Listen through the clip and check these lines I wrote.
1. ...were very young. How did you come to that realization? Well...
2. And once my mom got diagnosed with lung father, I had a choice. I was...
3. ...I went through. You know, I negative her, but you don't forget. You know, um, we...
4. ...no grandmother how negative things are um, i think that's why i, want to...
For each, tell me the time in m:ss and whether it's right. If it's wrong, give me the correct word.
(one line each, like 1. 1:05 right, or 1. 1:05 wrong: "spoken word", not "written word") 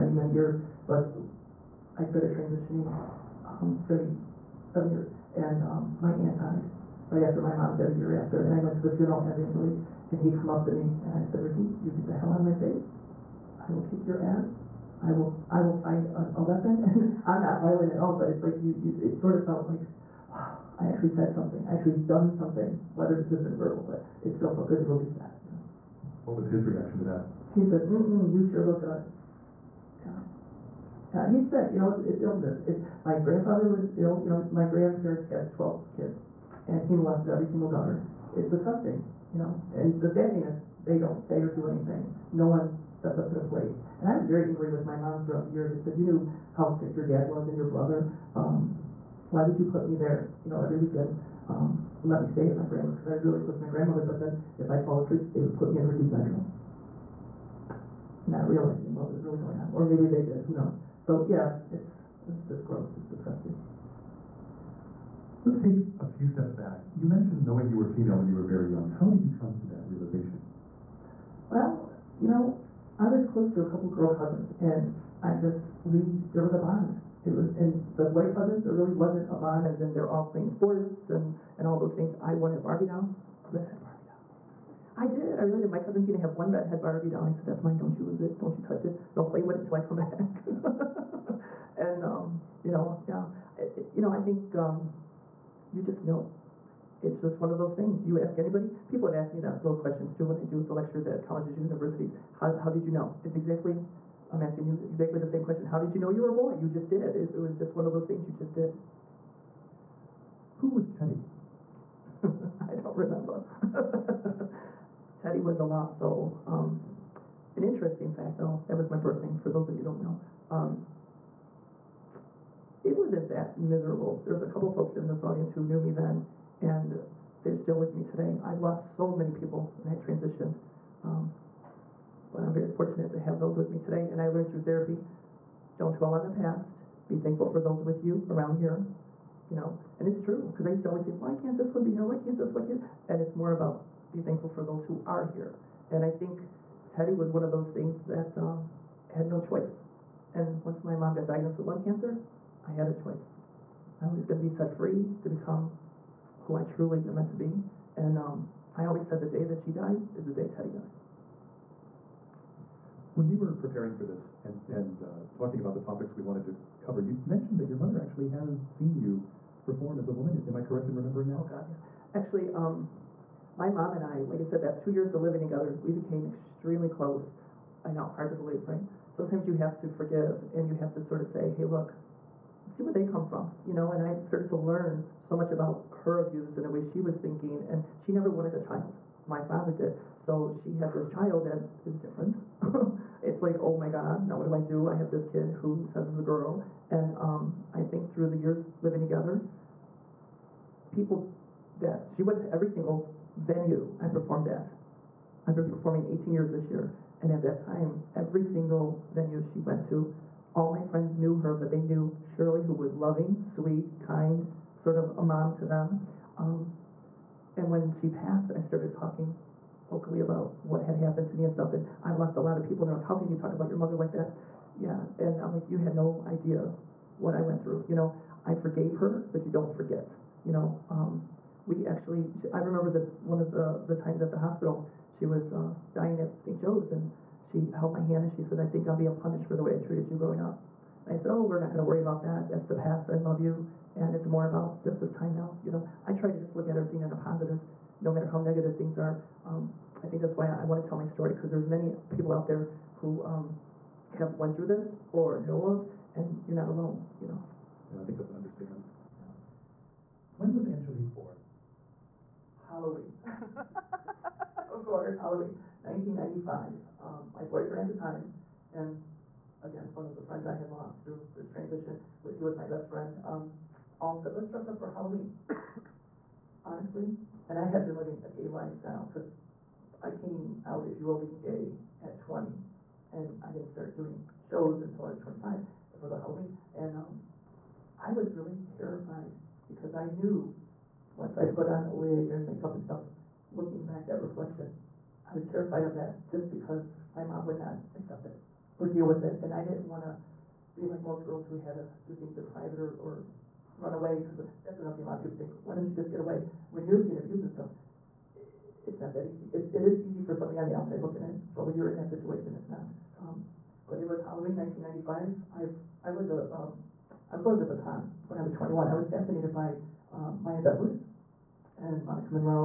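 1. 1:08 right
2. 2:30 wrong: "cancer", not "father"
3. 3:47 wrong: "forgave", not "negative"
4. 4:08 wrong: "matter", not "grandmother".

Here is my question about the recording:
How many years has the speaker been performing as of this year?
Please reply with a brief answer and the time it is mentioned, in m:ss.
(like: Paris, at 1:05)
18, at 3:26.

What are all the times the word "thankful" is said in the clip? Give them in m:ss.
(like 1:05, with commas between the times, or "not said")
2:17, 2:24.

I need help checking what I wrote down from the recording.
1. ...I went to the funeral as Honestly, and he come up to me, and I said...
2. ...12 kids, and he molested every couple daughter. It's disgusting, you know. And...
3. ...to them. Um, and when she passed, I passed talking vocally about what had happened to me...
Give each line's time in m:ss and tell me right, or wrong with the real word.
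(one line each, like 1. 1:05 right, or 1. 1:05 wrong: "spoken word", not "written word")
1. 0:08 wrong: "Angelique", not "Honestly"
2. 0:35 wrong: "single", not "couple"
3. 3:35 wrong: "started", not "passed".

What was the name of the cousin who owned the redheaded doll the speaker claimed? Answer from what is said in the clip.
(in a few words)
Tina.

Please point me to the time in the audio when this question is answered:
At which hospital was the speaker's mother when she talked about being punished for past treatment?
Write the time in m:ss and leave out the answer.
3:56.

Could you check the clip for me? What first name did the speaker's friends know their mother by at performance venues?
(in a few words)
Shirley.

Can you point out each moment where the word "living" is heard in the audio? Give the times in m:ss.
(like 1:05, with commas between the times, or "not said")
2:55, 3:18, 4:37.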